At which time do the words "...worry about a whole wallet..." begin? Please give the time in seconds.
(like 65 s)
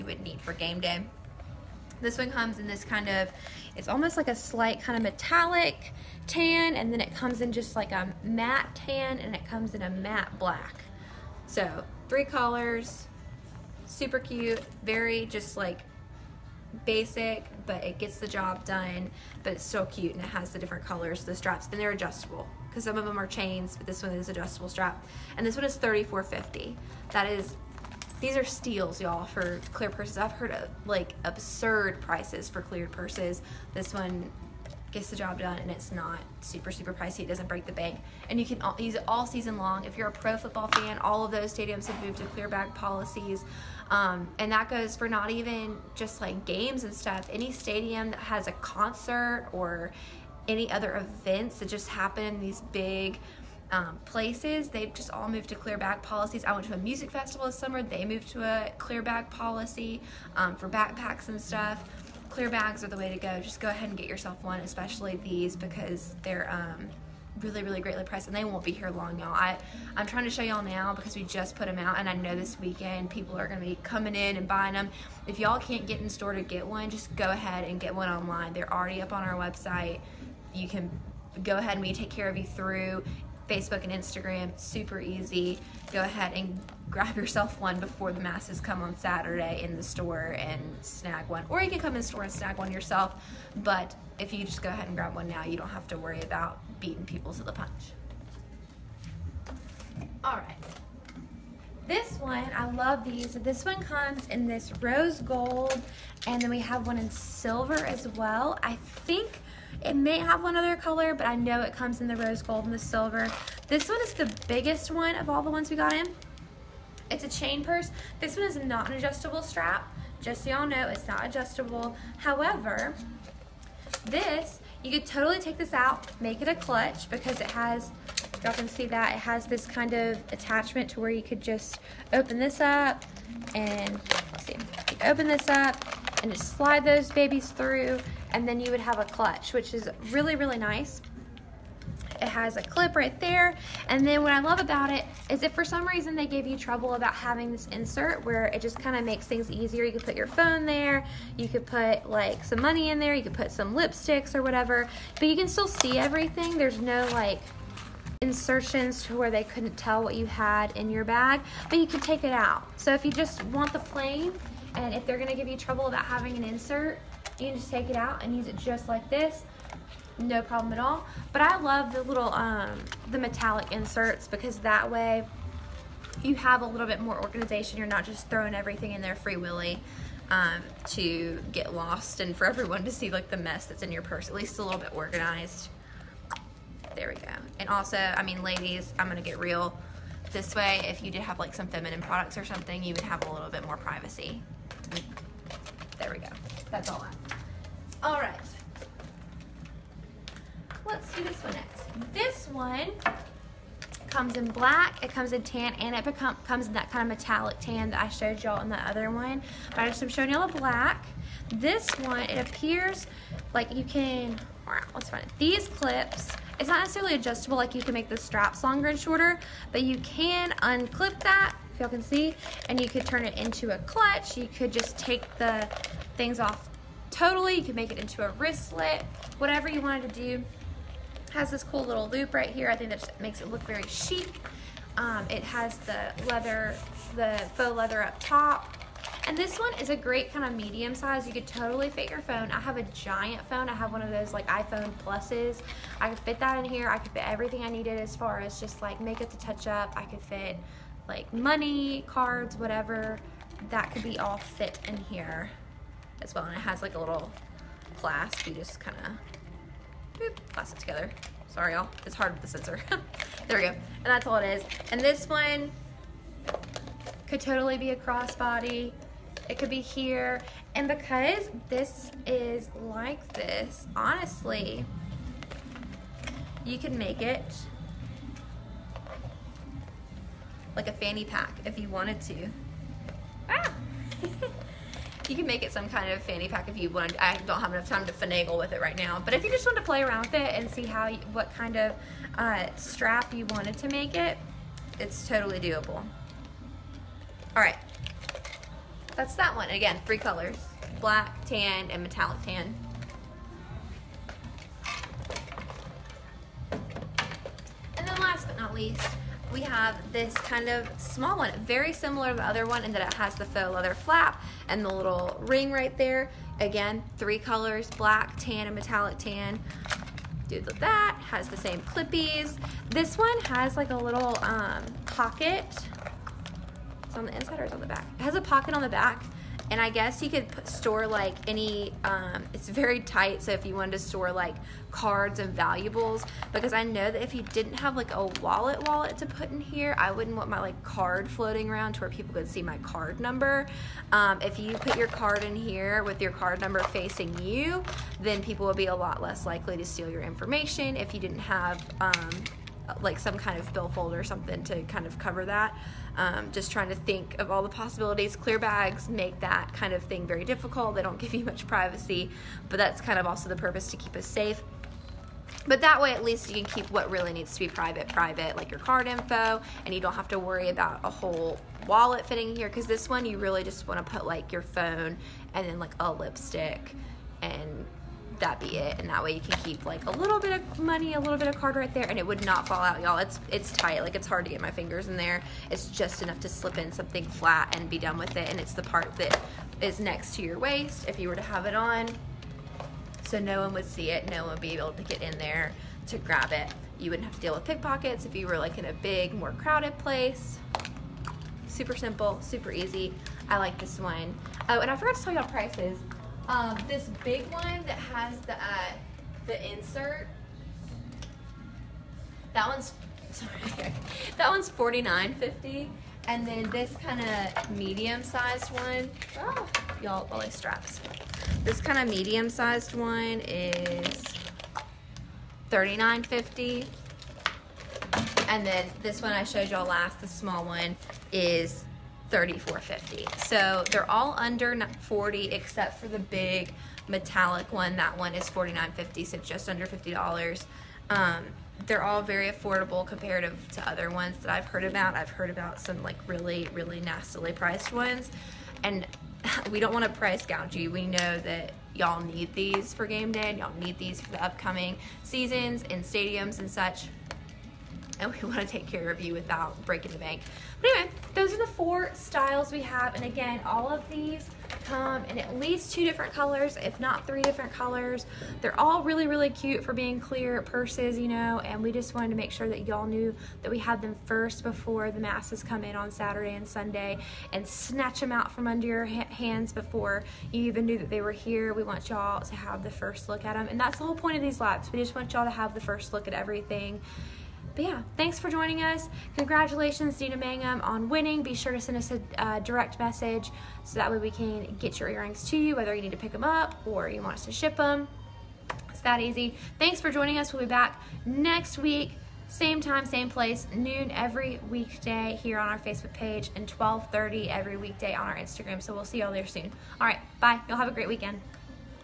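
370 s.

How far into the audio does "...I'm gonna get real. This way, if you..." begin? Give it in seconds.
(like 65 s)
188 s.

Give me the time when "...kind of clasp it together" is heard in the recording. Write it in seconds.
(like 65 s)
258 s.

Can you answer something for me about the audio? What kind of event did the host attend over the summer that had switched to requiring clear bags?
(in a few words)
A music festival.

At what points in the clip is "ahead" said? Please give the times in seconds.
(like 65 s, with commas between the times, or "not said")
63 s, 77 s, 81 s, 86 s, 94 s.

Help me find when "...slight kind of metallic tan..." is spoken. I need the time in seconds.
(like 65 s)
4 s.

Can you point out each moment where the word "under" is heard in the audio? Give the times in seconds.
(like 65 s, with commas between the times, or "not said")
434 s, 439 s, 478 s.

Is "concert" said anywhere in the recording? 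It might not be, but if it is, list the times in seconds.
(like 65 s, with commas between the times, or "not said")
48 s.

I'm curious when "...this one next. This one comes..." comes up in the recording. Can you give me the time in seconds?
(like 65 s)
201 s.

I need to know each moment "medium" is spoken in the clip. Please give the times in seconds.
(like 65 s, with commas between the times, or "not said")
240 s, 417 s, 422 s.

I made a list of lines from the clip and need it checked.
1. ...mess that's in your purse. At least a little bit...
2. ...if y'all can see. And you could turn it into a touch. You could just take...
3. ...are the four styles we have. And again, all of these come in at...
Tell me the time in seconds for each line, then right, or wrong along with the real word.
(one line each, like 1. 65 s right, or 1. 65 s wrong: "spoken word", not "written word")
1. 183 s right
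2. 221 s wrong: "clutch", not "touch"
3. 461 s right.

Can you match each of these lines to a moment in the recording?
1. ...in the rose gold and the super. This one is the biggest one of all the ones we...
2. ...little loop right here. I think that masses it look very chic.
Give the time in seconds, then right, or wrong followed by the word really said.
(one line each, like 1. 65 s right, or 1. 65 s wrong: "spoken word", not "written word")
1. 111 s wrong: "silver", not "super"
2. 231 s wrong: "makes", not "masses".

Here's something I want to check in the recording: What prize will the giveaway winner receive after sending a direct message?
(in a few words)
Earrings.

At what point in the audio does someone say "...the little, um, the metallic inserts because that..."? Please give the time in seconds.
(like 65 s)
171 s.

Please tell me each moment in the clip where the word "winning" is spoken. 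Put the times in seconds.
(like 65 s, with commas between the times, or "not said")
491 s.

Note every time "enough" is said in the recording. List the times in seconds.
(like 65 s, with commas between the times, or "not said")
287 s, 386 s.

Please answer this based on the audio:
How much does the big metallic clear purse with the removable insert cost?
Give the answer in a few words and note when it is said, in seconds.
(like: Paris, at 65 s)
$49.50, at 414 s.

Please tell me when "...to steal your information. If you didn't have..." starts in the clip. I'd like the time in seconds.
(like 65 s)
349 s.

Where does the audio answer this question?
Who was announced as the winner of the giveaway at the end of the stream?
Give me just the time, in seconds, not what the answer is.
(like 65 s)
490 s.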